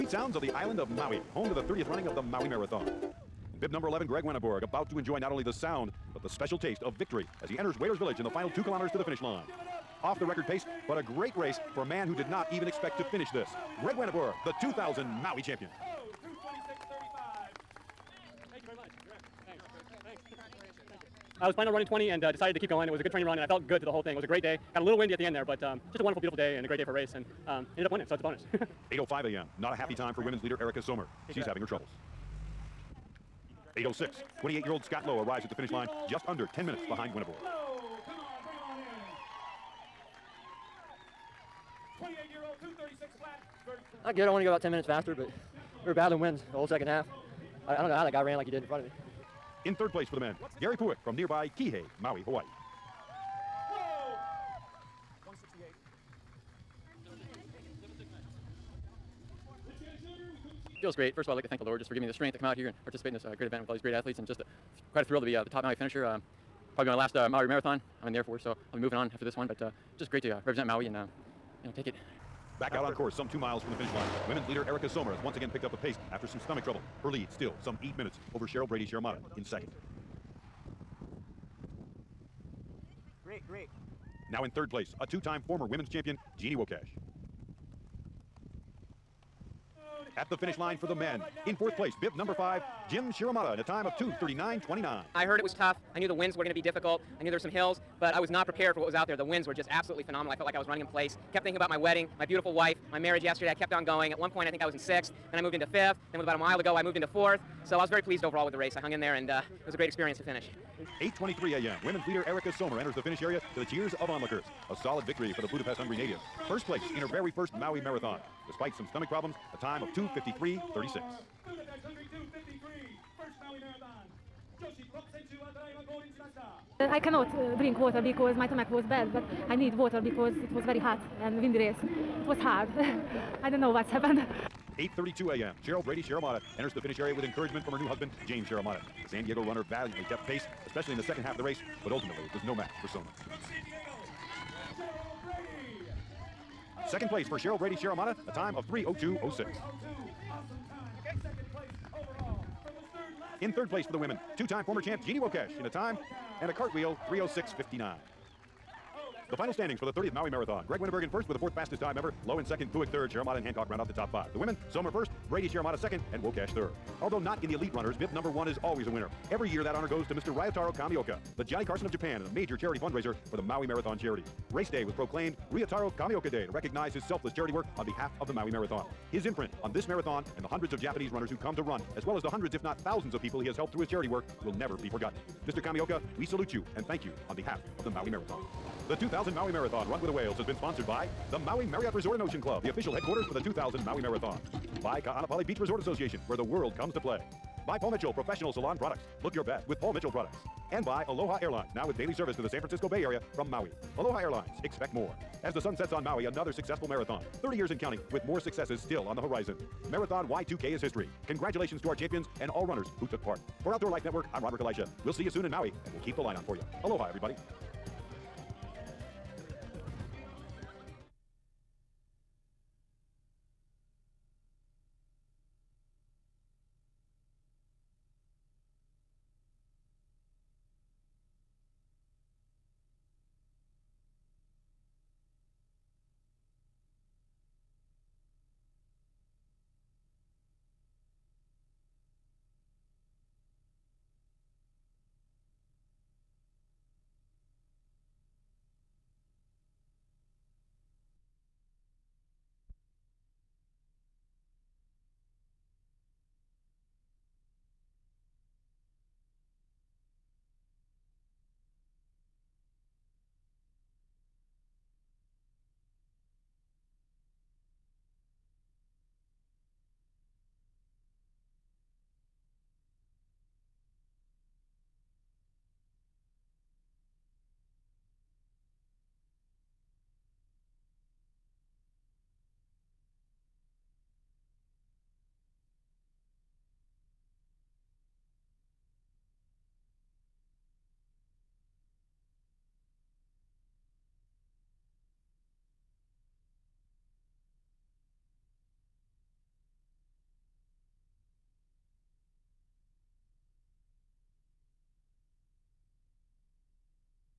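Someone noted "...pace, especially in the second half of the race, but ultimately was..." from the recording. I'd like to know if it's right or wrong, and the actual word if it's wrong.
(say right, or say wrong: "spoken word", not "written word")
right.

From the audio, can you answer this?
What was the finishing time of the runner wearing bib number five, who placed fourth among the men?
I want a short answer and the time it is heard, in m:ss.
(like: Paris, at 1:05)
2:39:29, at 1:33.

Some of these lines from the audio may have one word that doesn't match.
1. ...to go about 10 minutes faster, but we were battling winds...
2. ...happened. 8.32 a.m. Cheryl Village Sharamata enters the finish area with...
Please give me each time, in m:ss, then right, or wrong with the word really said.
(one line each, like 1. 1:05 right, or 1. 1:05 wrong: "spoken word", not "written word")
1. 0:44 right
2. 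2:13 wrong: "Brady", not "Village".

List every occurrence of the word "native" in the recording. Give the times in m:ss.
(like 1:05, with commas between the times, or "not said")
1:55.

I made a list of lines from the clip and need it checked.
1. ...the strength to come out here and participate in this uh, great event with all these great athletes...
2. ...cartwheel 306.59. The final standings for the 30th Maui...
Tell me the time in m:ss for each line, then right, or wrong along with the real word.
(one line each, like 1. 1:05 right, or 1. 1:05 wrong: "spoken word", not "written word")
1. 1:02 right
2. 2:36 right.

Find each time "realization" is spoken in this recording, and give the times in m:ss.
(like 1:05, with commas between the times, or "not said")
not said.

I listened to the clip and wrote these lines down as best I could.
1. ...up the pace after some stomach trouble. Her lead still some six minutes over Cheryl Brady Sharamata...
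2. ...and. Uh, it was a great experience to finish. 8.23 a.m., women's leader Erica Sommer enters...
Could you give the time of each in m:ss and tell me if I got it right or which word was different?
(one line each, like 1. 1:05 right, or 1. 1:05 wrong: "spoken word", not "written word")
1. 1:15 wrong: "eight", not "six"
2. 1:49 right.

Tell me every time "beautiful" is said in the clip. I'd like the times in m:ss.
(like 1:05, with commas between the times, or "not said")
0:26, 1:42.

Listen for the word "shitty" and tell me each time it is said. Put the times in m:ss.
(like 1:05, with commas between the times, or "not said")
not said.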